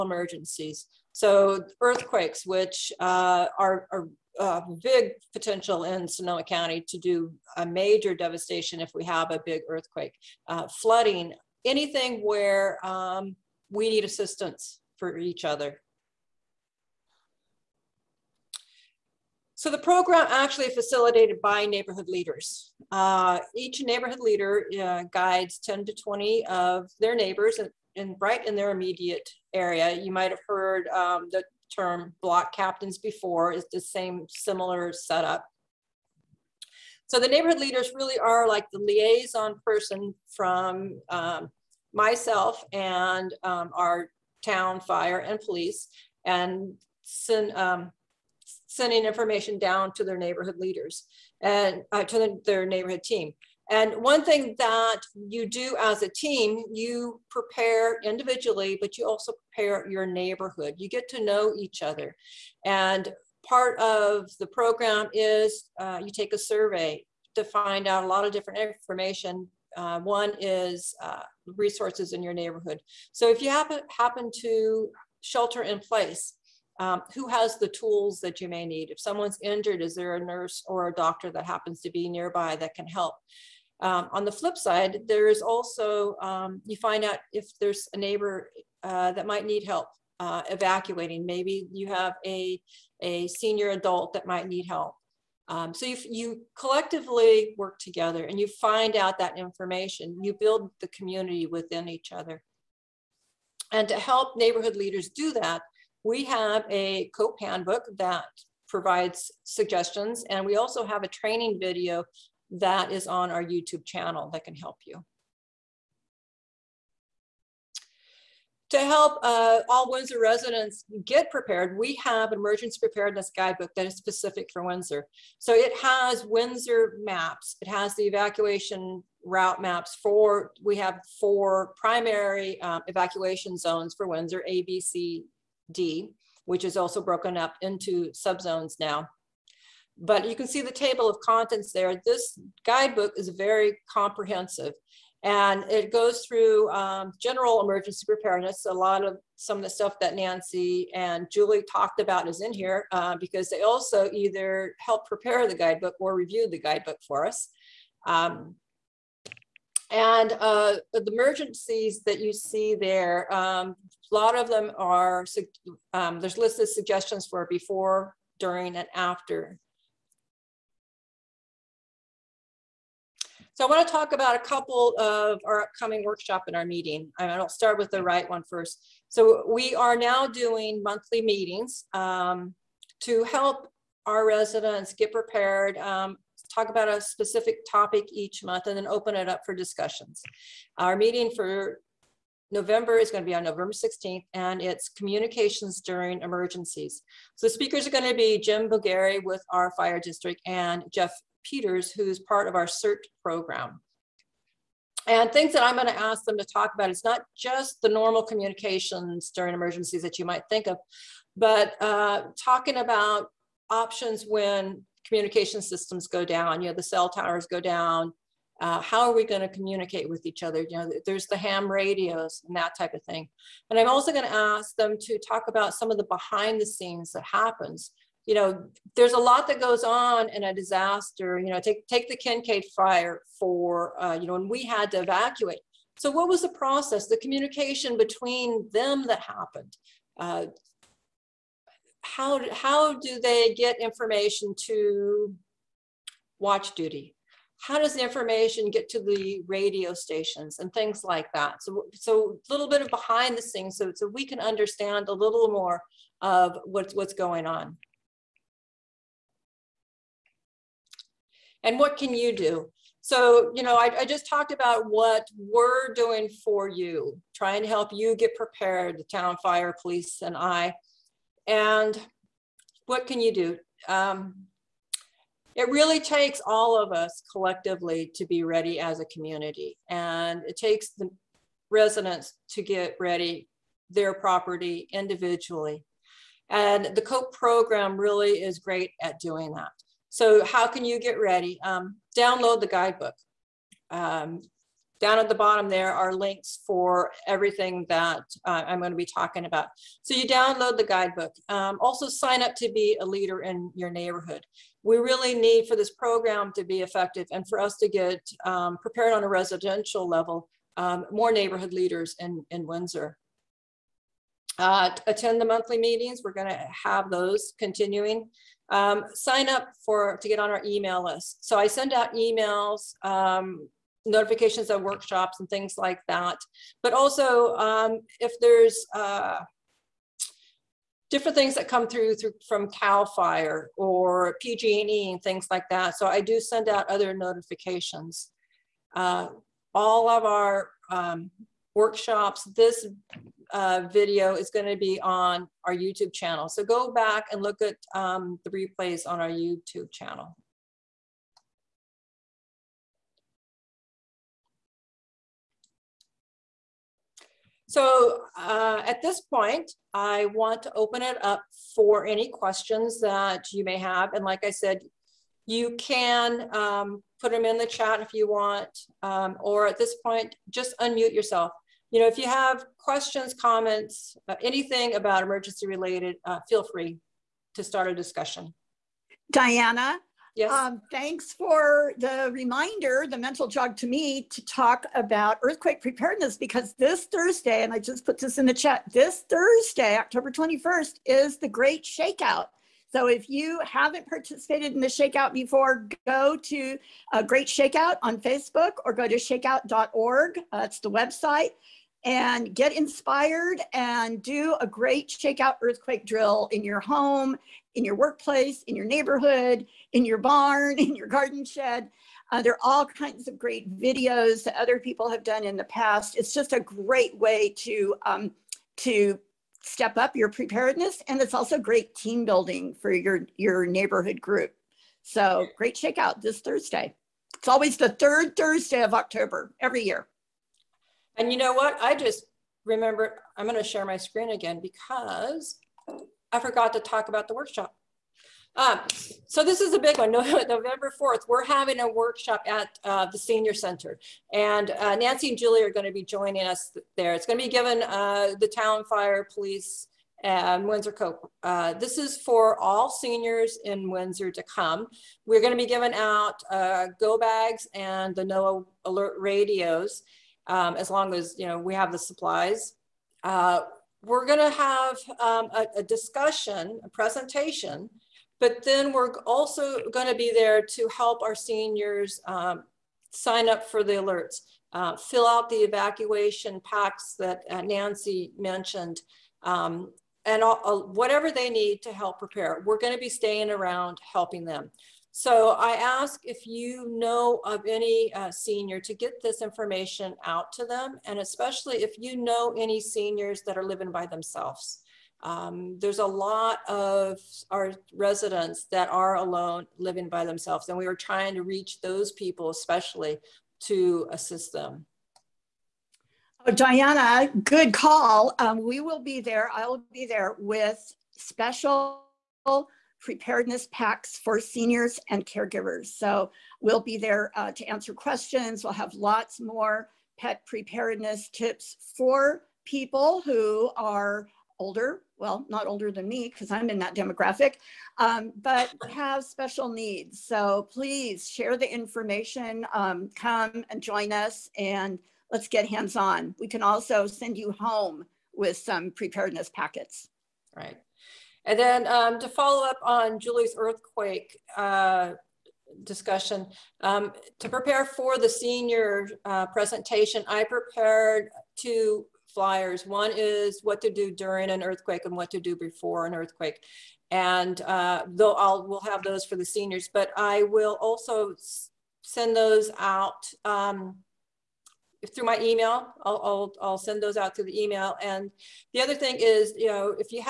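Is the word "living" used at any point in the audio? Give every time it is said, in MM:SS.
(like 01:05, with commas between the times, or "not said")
08:13, 08:19.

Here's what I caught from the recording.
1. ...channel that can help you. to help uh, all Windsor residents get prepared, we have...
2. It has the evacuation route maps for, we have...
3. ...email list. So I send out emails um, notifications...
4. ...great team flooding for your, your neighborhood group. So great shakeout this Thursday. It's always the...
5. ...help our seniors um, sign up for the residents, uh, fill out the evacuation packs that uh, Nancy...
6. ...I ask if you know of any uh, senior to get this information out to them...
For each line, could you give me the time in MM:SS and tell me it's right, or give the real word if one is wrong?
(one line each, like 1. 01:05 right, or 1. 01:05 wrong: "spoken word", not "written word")
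1. 01:53 right
2. 02:07 right
3. 05:20 right
4. 07:01 wrong: "building", not "flooding"
5. 07:50 wrong: "alerts", not "residents"
6. 08:05 right.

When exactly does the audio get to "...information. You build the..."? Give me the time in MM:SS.
01:39.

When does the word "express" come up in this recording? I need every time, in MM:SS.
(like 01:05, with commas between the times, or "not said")
not said.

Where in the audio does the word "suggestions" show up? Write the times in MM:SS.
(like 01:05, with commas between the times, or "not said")
01:49, 02:46.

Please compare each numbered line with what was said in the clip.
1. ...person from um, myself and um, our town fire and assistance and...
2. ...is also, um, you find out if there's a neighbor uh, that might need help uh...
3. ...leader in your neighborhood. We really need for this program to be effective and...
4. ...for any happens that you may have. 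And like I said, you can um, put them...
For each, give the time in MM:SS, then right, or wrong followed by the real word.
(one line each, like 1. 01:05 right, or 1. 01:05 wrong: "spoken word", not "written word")
1. 00:39 wrong: "police", not "assistance"
2. 01:25 right
3. 05:03 right
4. 06:01 wrong: "questions", not "happens".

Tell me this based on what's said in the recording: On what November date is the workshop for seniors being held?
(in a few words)
November 4th.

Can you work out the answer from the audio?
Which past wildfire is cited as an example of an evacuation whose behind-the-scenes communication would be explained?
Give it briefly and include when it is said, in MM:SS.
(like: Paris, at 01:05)
Kincade fire, at 03:52.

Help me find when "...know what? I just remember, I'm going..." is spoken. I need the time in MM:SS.
07:11.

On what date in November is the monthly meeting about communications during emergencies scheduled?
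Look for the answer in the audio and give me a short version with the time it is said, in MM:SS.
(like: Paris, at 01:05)
November 16th, at 03:13.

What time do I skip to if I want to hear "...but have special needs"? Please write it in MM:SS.
08:48.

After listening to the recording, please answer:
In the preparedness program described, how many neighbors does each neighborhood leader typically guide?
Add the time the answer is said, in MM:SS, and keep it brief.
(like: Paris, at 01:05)
10 to 20, at 00:25.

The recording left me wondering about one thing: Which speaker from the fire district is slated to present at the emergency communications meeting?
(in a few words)
Jim Bulgari.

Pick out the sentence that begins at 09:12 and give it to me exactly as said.
One is what to do during an earthquake and what to do before an earthquake.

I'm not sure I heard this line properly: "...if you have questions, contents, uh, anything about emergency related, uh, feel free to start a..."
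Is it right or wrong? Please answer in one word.
wrong.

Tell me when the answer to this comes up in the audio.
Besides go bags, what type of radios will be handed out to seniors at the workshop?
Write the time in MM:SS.
07:38.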